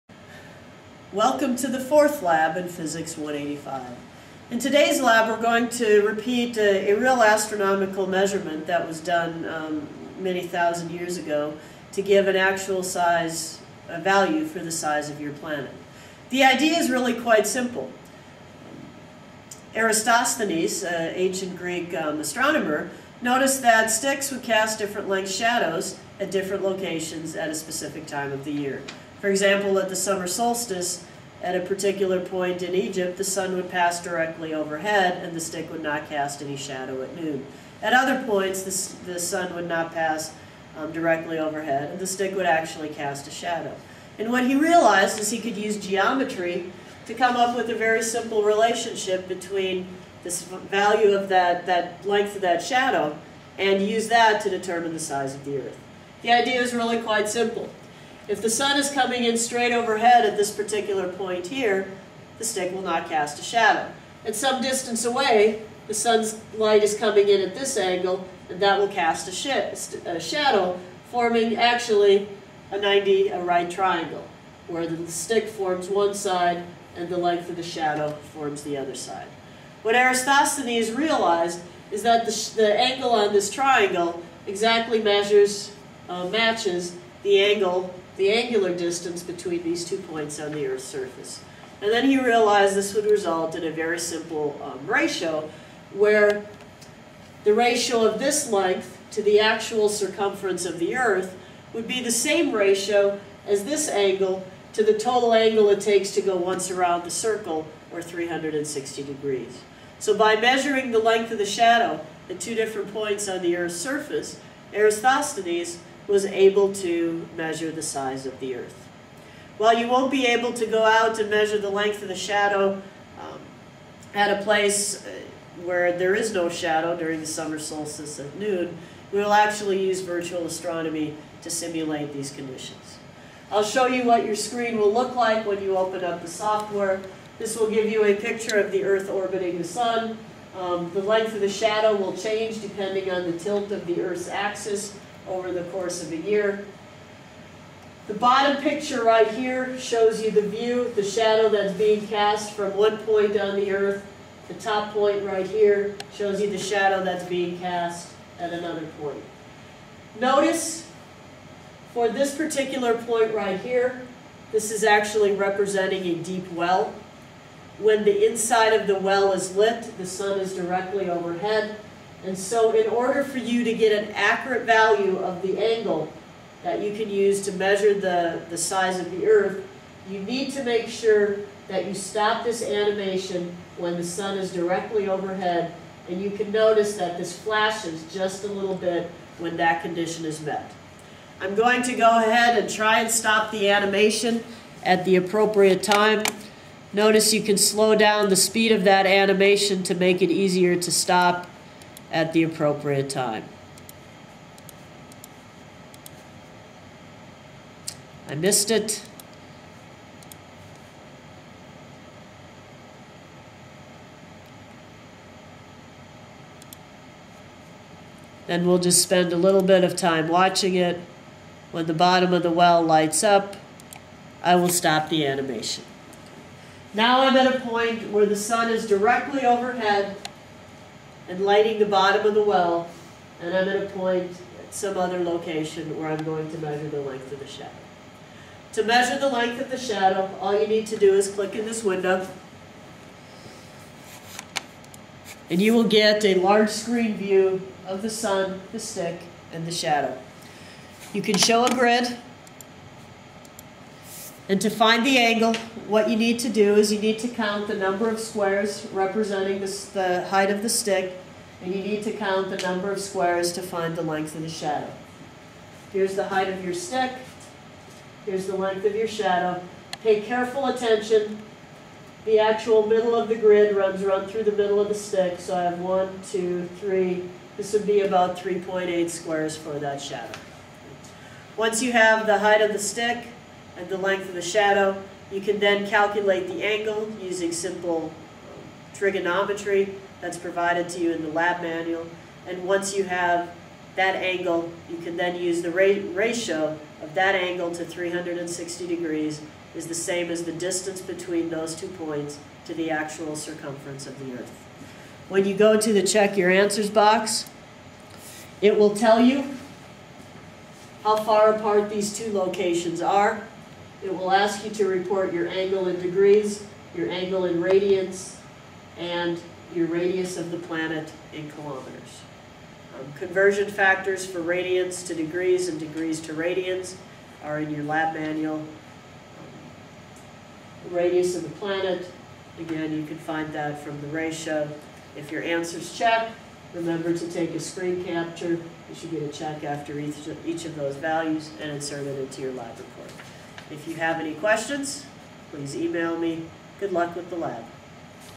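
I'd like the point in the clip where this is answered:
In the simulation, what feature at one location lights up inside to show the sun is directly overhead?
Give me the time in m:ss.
2:46.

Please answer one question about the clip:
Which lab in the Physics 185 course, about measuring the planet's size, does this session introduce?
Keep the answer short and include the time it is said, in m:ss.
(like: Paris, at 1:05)
fourth, at 0:01.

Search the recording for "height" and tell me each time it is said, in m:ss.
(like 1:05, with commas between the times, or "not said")
4:20, 4:26, 4:42.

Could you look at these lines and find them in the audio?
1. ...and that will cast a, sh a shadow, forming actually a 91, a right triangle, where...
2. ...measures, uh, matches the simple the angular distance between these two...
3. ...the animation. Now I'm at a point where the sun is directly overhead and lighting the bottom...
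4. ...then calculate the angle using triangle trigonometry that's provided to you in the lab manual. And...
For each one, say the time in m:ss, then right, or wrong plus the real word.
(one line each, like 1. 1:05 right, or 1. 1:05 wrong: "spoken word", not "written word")
1. 1:08 wrong: "90", not "91"
2. 1:25 wrong: "angle", not "simple"
3. 3:45 right
4. 4:45 wrong: "simple", not "triangle".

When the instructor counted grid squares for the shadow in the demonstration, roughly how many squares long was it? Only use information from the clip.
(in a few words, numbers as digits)
3.8.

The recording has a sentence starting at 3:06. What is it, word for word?
And you can notice that this flashes just a little bit when that condition is met.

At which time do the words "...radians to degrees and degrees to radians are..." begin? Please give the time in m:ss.
5:24.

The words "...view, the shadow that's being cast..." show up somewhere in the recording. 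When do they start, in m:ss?
2:30.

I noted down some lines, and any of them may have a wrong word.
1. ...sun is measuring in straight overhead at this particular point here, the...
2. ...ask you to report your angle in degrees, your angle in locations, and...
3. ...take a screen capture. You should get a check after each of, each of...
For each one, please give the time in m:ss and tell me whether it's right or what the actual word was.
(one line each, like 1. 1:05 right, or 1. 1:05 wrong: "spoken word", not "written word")
1. 0:58 wrong: "coming", not "measuring"
2. 5:14 wrong: "radians", not "locations"
3. 5:37 right.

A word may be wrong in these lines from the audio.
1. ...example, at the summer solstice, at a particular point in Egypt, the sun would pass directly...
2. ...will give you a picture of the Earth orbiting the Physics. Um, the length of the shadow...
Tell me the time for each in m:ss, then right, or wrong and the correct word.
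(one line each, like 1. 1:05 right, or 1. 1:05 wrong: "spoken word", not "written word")
1. 0:29 right
2. 2:17 wrong: "Sun", not "Physics".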